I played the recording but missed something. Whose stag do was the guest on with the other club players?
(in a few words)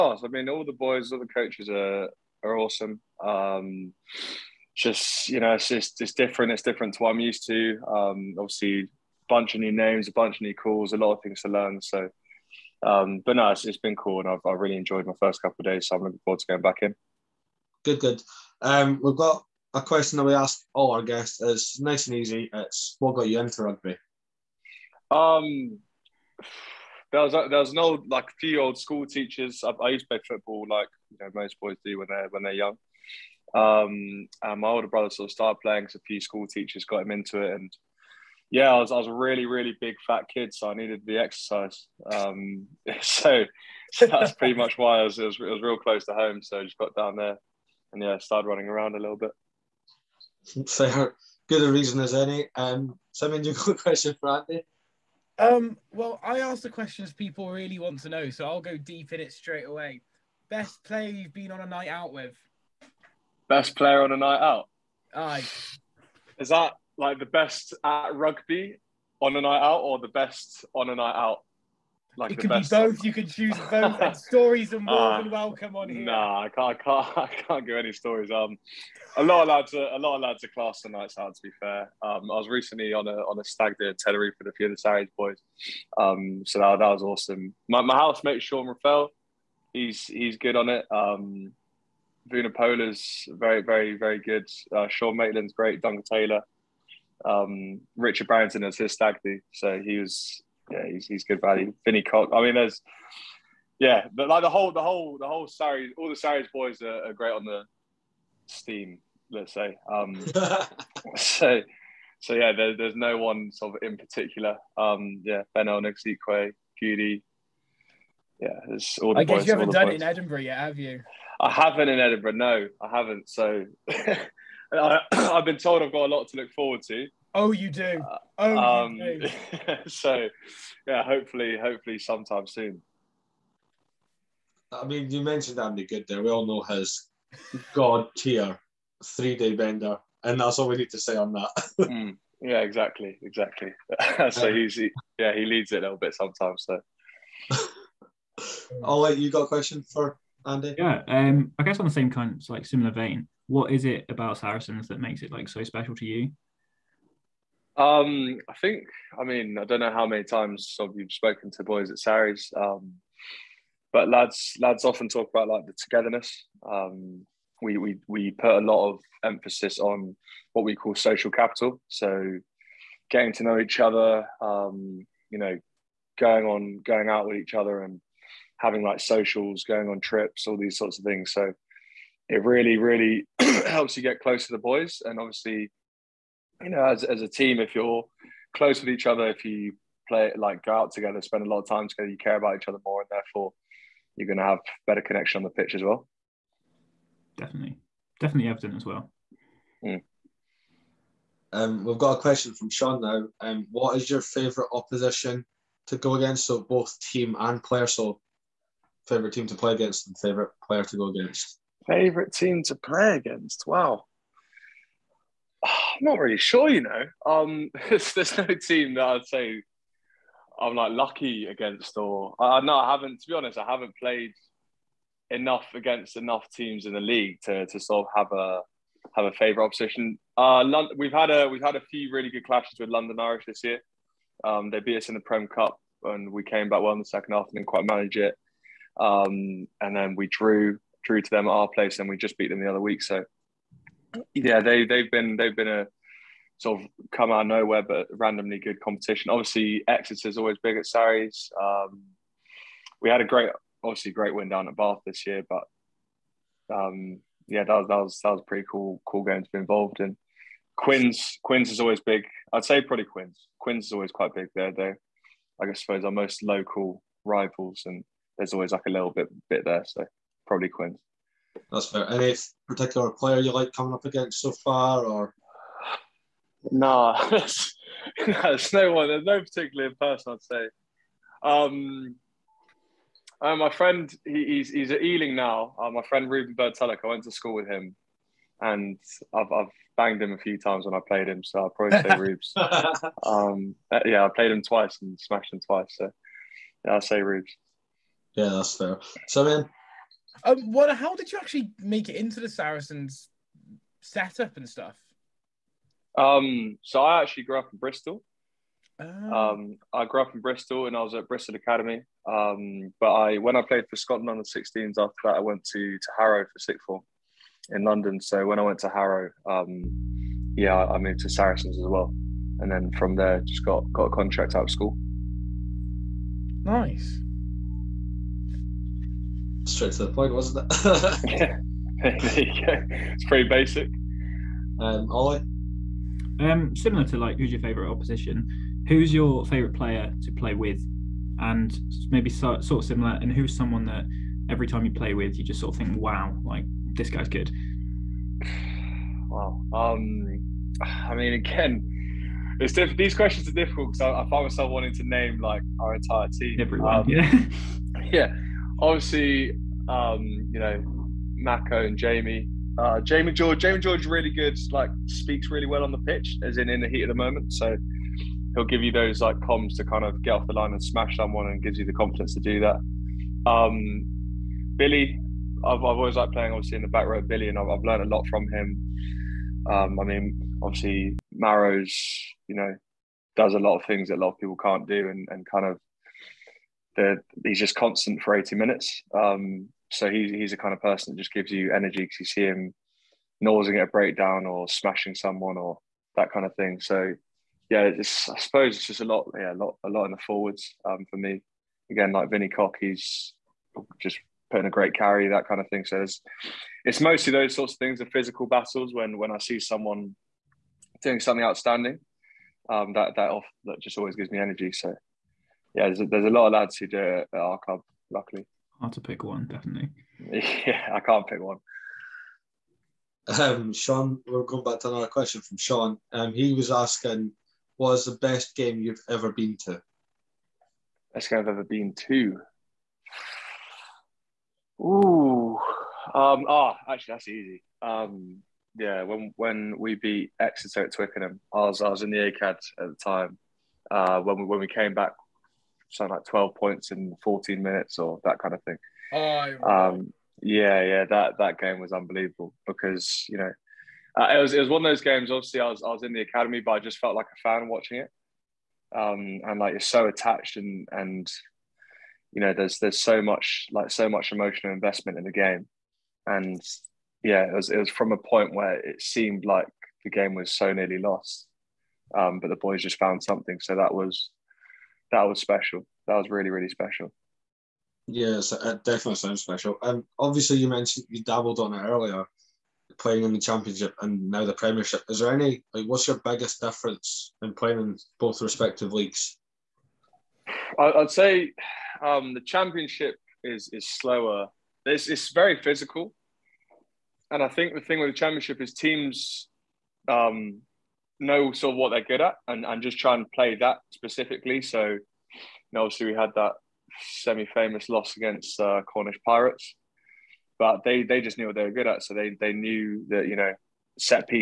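Richard Barrington.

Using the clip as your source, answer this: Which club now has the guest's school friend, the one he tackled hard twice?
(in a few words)
Ealing.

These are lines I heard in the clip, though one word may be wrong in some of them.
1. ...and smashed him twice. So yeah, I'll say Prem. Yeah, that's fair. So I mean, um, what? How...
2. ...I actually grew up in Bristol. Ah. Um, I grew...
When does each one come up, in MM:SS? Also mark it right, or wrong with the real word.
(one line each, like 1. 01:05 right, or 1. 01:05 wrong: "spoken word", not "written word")
1. 04:55 wrong: "Rubes", not "Prem"
2. 05:07 right.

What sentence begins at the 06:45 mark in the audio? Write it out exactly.
So it's, it's mostly those sorts of things, the physical battles.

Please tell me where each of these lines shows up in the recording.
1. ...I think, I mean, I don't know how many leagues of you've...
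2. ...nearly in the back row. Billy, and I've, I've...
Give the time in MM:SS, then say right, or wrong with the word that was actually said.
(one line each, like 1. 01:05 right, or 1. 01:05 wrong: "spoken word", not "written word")
1. 02:38 wrong: "times", not "leagues"
2. 06:16 wrong: "obviously", not "nearly".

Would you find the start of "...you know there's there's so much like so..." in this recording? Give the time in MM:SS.
07:42.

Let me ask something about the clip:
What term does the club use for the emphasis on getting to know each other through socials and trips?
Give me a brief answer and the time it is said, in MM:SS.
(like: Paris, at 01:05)
social capital, at 02:50.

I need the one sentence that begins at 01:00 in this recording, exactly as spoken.
Best player you've been on a night out with?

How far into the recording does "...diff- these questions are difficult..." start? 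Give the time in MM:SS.
05:52.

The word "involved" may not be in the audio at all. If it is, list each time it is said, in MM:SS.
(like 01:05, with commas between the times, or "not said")
04:19.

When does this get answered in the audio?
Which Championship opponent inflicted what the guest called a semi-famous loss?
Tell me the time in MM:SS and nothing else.
08:28.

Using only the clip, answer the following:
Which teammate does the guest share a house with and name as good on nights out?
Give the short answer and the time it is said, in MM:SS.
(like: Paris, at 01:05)
Sean Reffell, at 01:28.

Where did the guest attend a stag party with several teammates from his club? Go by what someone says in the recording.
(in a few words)
Tenerife.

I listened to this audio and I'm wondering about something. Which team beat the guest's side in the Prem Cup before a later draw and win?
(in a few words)
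London Irish.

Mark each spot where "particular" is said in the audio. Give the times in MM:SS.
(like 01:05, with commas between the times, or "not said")
01:53, 04:32, 04:39.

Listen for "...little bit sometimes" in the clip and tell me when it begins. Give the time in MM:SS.
02:25.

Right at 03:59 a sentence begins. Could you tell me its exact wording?
Um, and then we drew drew to them at our place, and we just beat them the other week.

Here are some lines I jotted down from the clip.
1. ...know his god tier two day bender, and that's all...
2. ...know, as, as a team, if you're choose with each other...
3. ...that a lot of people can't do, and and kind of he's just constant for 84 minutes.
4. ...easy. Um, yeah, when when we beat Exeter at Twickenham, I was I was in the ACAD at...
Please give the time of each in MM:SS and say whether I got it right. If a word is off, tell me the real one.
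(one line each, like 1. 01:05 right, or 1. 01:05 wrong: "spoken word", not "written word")
1. 02:16 wrong: "three", not "two"
2. 03:06 wrong: "close", not "choose"
3. 06:24 wrong: "80", not "84"
4. 07:17 right.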